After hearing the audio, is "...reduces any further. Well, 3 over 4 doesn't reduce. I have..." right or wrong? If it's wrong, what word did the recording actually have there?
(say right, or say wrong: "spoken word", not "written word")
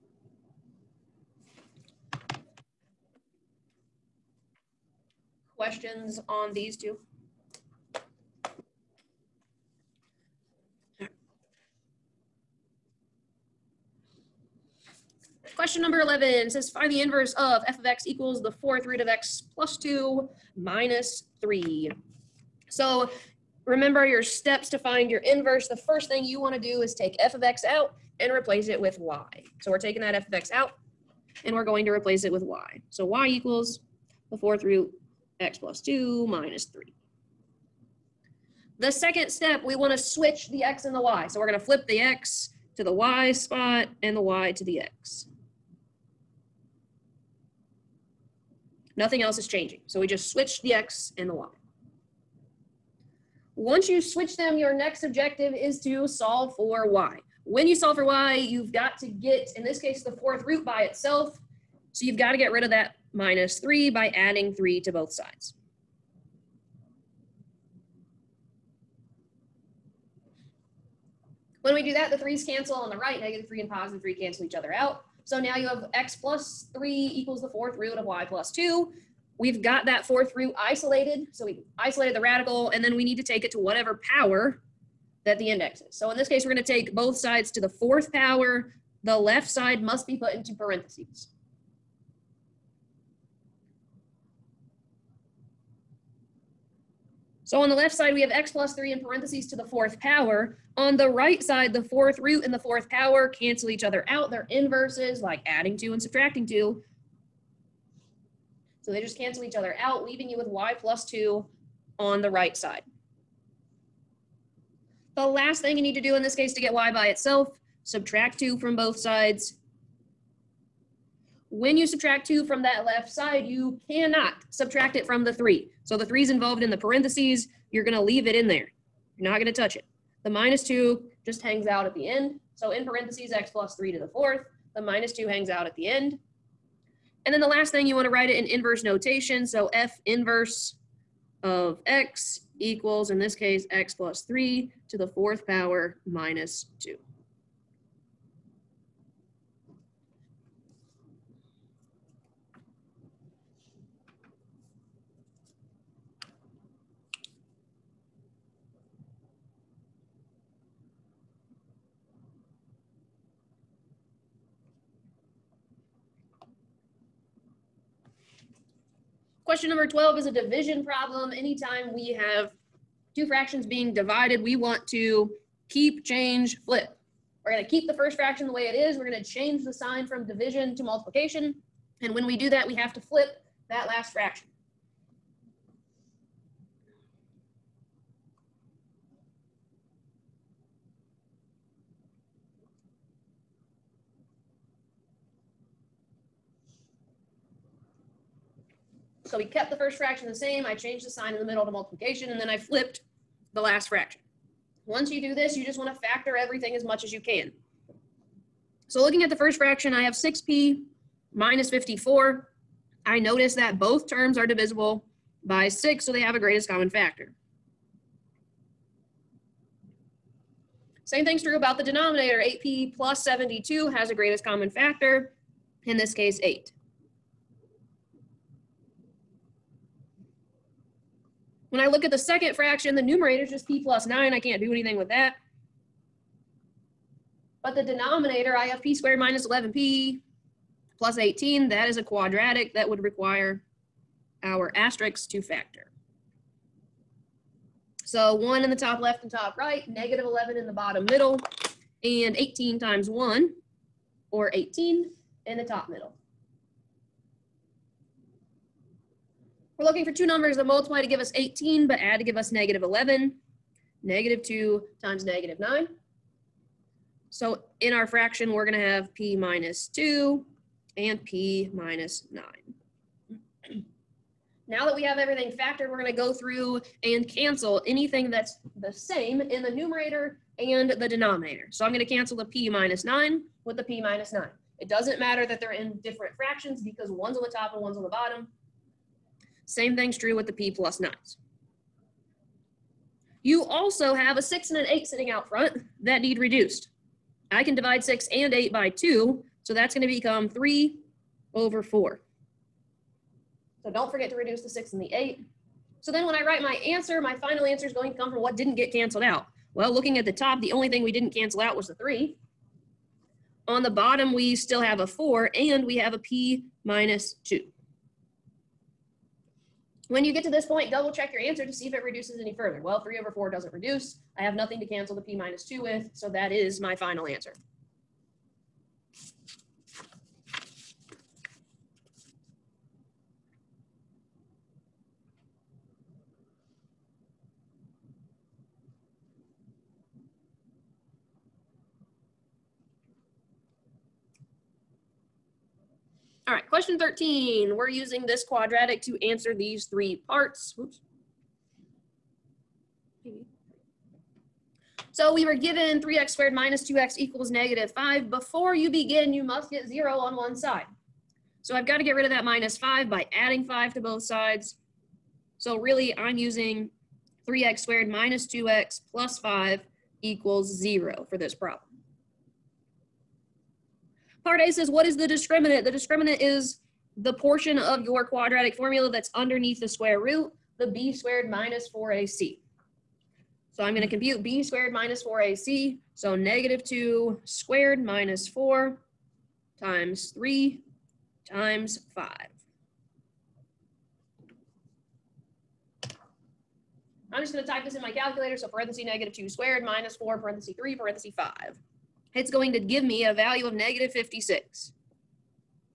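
right.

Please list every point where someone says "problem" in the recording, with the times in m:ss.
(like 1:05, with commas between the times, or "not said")
2:50, 6:11.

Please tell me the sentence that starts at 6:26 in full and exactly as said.
So negative 2 squared minus 4 times 3 times 5.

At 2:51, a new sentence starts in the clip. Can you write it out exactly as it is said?
Anytime we have two fractions being divided, we want to keep, change, flip.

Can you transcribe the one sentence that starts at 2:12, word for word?
So in parentheses, x plus three to the fourth.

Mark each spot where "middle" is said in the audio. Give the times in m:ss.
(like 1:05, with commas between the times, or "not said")
3:21, 4:11, 4:15.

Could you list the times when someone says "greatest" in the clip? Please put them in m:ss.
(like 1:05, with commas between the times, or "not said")
3:36, 3:44.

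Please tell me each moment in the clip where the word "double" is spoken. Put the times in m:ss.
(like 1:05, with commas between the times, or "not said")
5:20.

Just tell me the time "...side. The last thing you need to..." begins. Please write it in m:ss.
1:52.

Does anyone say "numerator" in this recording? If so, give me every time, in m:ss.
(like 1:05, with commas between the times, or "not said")
3:53, 4:39.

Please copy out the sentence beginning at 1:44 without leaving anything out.
They're inverses, like adding two and subtracting two.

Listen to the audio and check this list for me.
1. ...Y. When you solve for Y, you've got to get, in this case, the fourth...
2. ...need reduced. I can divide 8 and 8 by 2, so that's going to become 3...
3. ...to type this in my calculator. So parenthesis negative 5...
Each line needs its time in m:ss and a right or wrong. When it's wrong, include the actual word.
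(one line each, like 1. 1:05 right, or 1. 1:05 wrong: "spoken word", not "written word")
1. 0:56 right
2. 4:56 wrong: "6", not "8"
3. 6:37 wrong: "2", not "5".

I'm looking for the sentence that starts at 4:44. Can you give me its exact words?
It doesn't matter that they're in different fractions because one's on the top and one's on the bottom.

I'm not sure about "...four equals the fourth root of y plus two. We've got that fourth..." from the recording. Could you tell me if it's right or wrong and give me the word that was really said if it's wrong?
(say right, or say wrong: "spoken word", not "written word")
wrong: "three", not "four".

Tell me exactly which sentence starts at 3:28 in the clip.
So looking at the first fraction, I have 6p minus 54.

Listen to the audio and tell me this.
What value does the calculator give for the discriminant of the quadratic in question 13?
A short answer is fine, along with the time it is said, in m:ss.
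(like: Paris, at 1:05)
-56, at 6:43.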